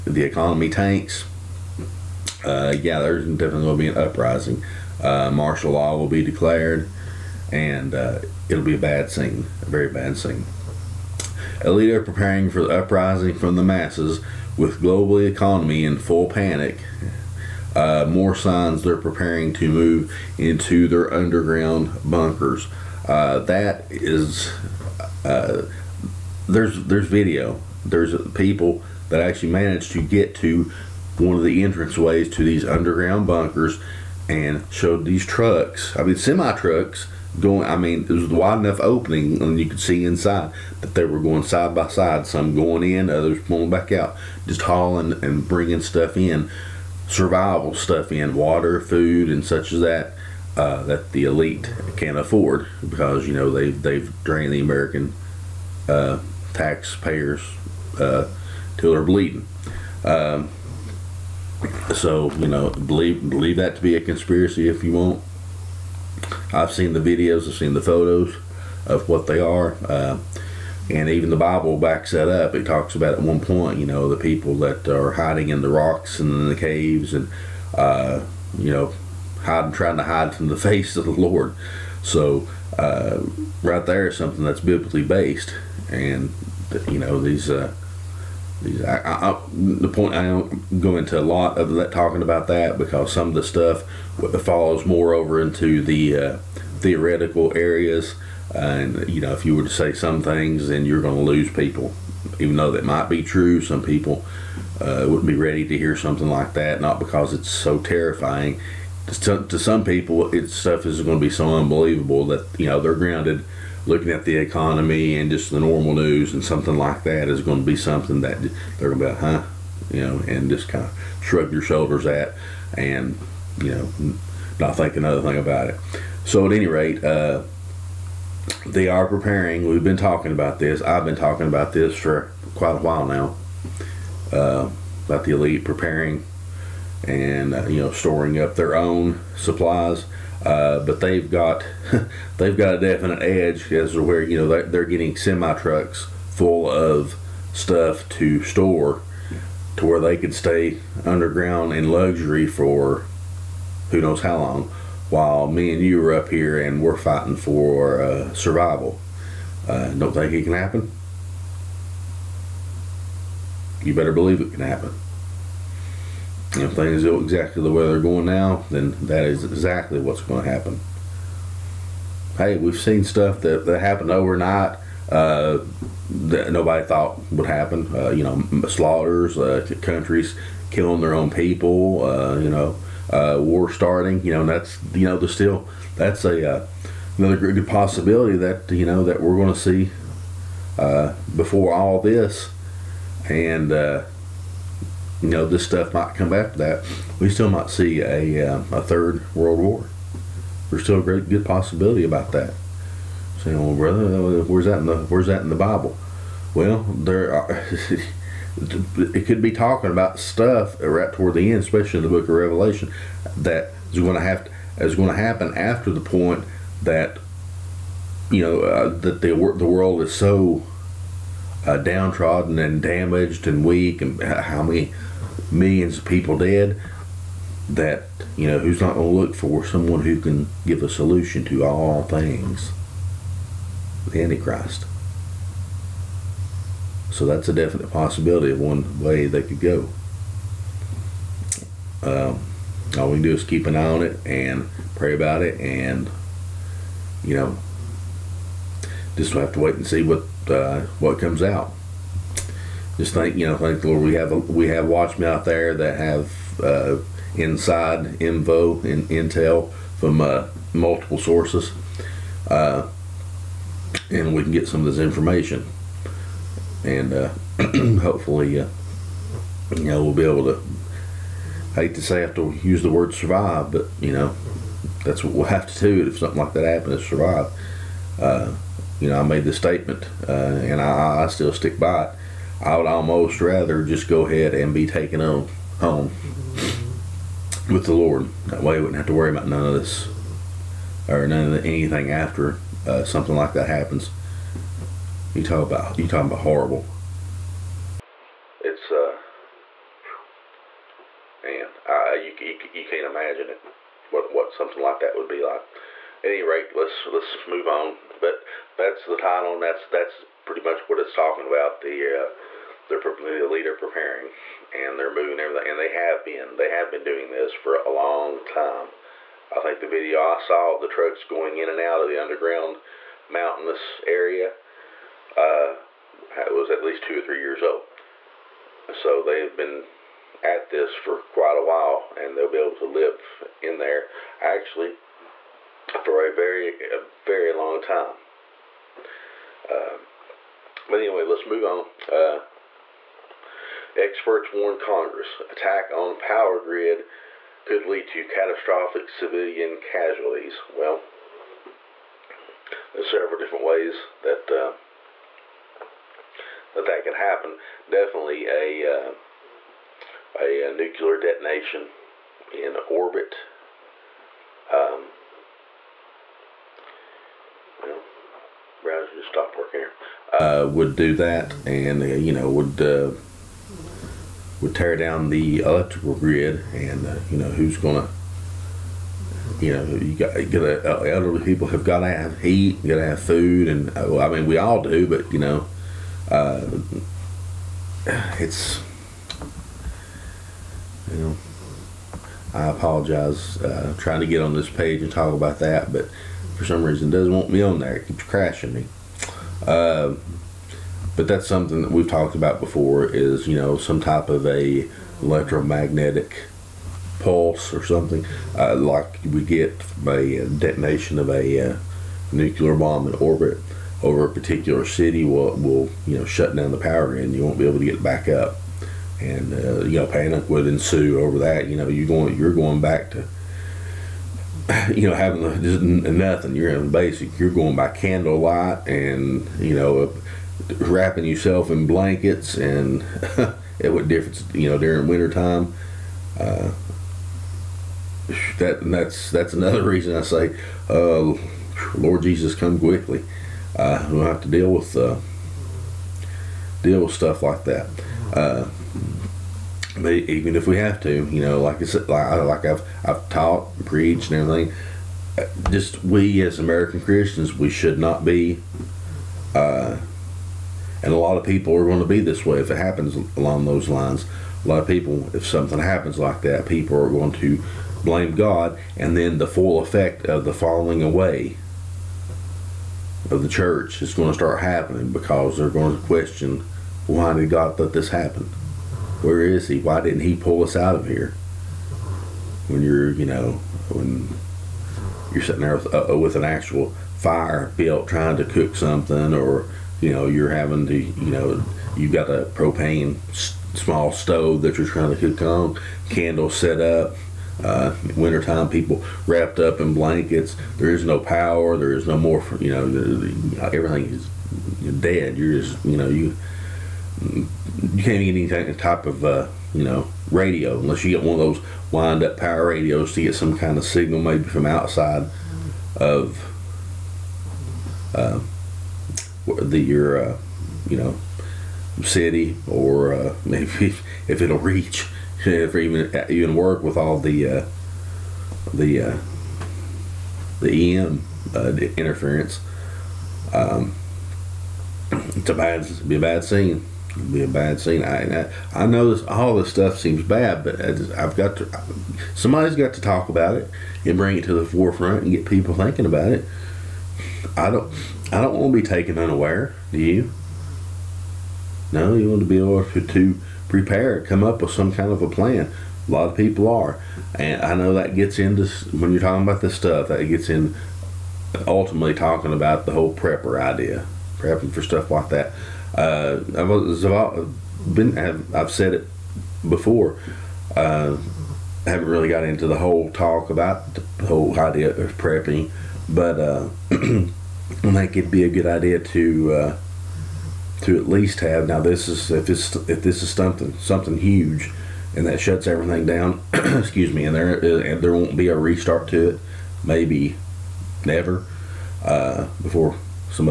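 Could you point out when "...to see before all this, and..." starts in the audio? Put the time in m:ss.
3:09.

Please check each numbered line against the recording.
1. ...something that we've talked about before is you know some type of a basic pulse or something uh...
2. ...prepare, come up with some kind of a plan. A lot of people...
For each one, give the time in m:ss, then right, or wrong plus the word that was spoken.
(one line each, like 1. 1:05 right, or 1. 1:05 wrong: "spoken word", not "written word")
1. 6:41 wrong: "electromagnetic", not "basic"
2. 9:13 right.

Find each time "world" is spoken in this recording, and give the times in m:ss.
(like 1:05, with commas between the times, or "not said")
3:19, 3:39.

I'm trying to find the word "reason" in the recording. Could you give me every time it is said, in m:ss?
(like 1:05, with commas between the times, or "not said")
6:36, 7:19.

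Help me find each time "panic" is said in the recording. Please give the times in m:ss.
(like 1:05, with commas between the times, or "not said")
0:16, 7:00.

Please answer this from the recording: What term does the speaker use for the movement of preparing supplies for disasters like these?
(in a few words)
prepper.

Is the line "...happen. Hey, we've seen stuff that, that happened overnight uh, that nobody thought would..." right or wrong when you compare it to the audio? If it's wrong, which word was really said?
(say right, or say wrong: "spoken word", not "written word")
right.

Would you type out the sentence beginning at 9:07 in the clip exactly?
I don't I don't want to be taken unaware.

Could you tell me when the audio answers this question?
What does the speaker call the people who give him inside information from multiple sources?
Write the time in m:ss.
4:14.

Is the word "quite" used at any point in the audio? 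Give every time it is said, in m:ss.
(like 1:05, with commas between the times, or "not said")
2:12, 5:31.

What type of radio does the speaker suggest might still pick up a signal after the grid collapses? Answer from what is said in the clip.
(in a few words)
wind up power radios.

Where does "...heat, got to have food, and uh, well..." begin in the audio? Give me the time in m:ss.
6:22.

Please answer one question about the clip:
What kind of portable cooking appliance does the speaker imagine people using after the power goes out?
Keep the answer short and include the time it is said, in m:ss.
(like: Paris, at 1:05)
propane small stove, at 8:12.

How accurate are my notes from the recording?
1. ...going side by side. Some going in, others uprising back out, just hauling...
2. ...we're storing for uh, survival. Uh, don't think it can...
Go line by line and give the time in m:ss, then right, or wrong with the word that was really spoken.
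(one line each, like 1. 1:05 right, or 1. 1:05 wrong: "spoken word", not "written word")
1. 0:41 wrong: "pulling", not "uprising"
2. 2:36 wrong: "fighting", not "storing".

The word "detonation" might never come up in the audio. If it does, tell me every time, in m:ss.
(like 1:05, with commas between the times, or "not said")
6:01, 6:50.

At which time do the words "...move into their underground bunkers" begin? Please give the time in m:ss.
0:19.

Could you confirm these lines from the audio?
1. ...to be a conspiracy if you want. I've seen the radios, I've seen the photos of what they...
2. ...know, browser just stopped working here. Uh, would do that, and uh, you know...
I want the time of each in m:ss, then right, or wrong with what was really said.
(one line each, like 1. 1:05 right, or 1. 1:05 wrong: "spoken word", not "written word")
1. 1:03 wrong: "videos", not "radios"
2. 6:07 right.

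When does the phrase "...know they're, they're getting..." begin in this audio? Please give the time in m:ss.
2:24.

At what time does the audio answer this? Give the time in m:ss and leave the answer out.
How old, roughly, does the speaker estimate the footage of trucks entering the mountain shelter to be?
5:27.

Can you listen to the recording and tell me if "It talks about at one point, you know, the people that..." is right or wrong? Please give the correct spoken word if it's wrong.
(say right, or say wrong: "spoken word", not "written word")
right.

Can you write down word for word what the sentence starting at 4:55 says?
You talk about you talking about horrible.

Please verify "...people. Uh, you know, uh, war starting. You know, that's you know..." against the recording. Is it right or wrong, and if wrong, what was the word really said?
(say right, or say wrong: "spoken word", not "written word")
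right.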